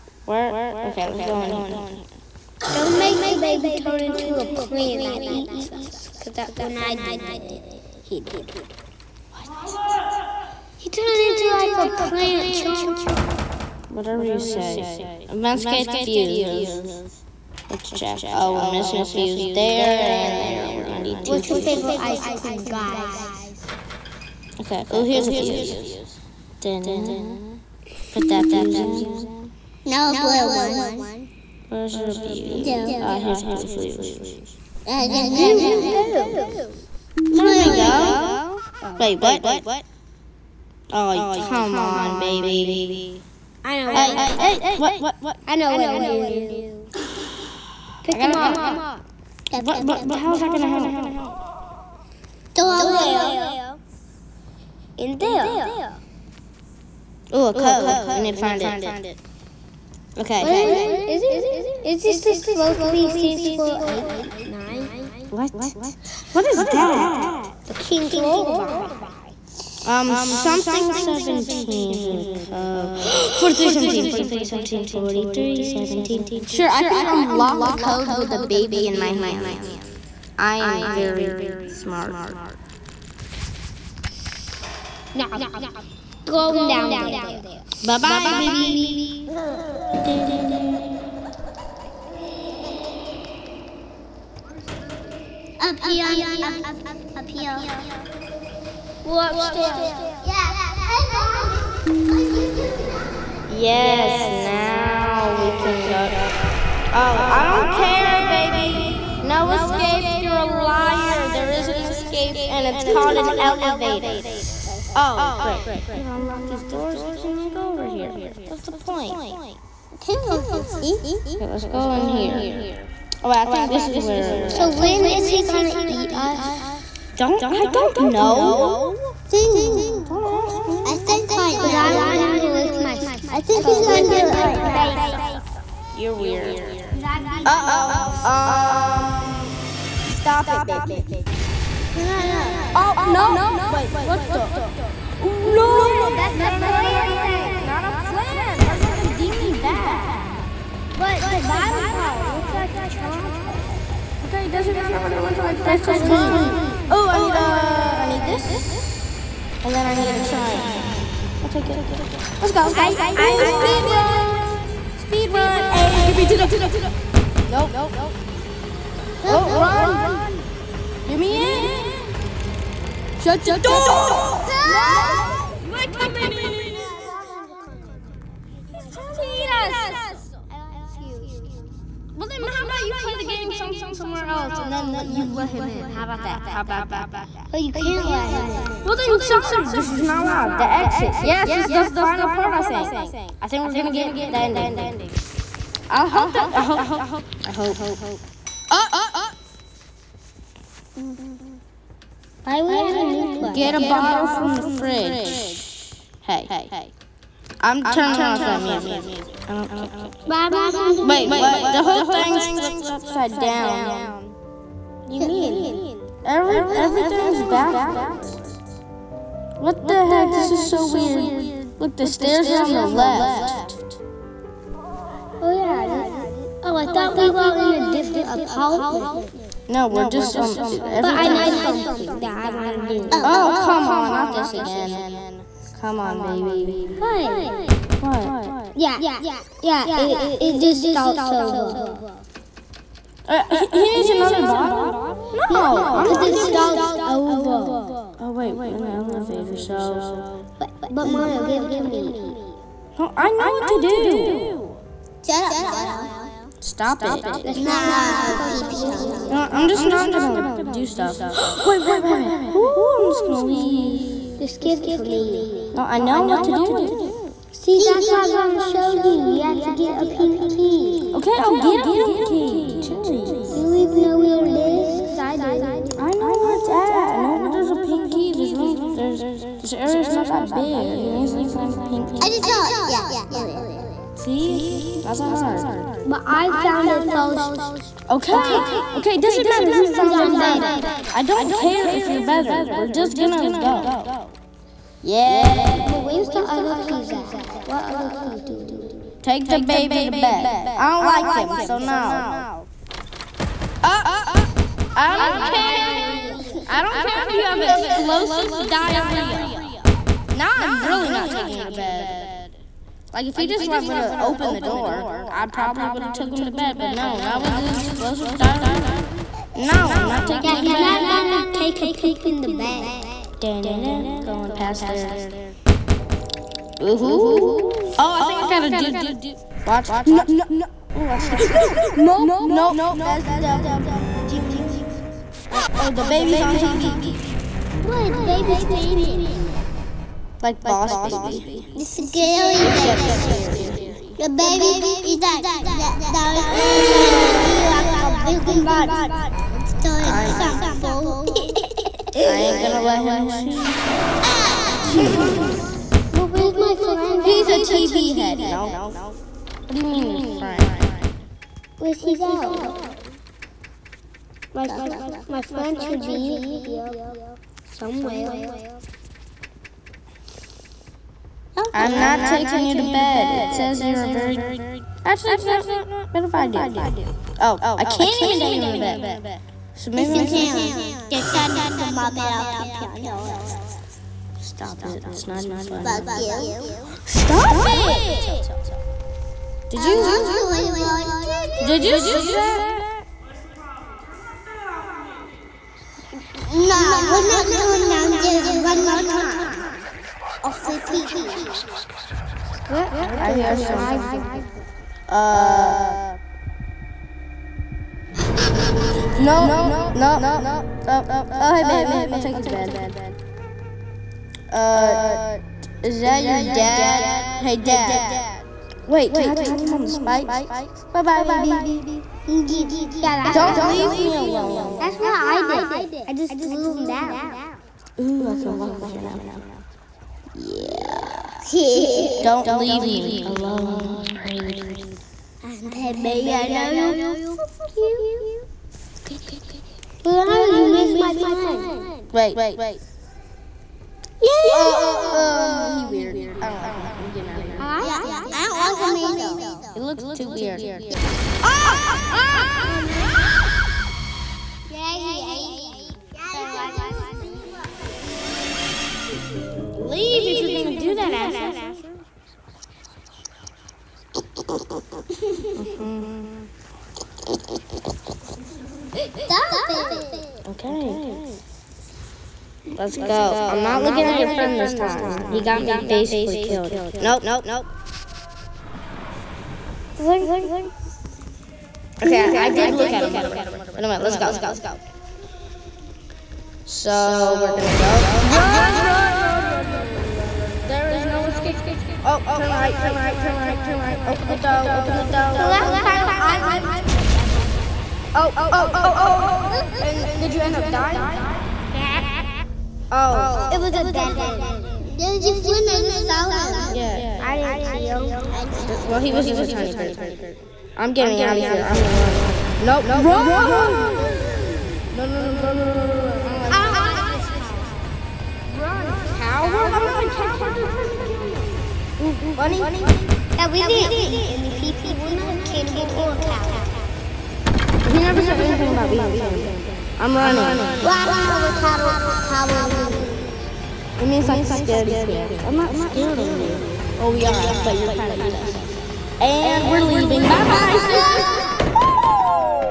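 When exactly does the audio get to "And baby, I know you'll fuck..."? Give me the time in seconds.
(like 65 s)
435 s.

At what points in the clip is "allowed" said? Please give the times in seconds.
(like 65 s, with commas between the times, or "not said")
190 s.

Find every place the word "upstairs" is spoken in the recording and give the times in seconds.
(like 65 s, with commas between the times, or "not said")
99 s.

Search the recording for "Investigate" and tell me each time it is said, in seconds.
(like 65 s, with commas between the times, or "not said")
15 s.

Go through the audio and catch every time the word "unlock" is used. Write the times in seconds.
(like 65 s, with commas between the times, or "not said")
77 s, 116 s.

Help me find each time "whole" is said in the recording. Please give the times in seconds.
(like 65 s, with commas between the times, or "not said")
211 s.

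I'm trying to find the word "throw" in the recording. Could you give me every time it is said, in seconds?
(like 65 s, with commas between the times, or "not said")
52 s, 419 s.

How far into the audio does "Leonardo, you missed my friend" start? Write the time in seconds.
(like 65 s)
440 s.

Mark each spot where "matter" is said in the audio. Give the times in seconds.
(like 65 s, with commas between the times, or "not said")
154 s, 289 s.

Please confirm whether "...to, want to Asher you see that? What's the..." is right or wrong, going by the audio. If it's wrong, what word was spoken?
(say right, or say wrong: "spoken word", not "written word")
wrong: "Did", not "Asher".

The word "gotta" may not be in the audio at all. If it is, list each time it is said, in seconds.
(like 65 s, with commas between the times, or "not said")
115 s, 328 s.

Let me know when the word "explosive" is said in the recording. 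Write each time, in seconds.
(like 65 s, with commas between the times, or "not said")
307 s, 317 s.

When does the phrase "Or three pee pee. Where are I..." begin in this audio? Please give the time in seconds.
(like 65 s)
400 s.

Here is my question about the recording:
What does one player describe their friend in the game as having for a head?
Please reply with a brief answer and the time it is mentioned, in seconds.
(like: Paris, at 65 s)
A TV, at 357 s.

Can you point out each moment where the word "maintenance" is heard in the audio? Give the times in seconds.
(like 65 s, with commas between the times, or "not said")
not said.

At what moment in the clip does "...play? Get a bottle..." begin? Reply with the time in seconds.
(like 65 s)
203 s.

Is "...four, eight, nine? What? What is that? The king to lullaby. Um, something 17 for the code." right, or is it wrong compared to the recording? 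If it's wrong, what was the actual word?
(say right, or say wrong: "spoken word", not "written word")
right.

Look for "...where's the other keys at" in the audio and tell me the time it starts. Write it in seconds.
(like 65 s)
296 s.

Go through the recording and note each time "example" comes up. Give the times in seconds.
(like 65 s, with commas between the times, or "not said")
350 s.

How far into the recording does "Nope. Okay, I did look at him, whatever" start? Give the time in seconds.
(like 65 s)
476 s.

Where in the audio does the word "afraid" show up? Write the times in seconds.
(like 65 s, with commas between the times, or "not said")
433 s.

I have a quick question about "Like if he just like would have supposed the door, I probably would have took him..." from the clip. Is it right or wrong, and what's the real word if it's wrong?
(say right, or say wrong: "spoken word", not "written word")
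wrong: "opened", not "supposed".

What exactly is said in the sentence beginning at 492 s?
Oh, turn right, turn right, turn right, turn right.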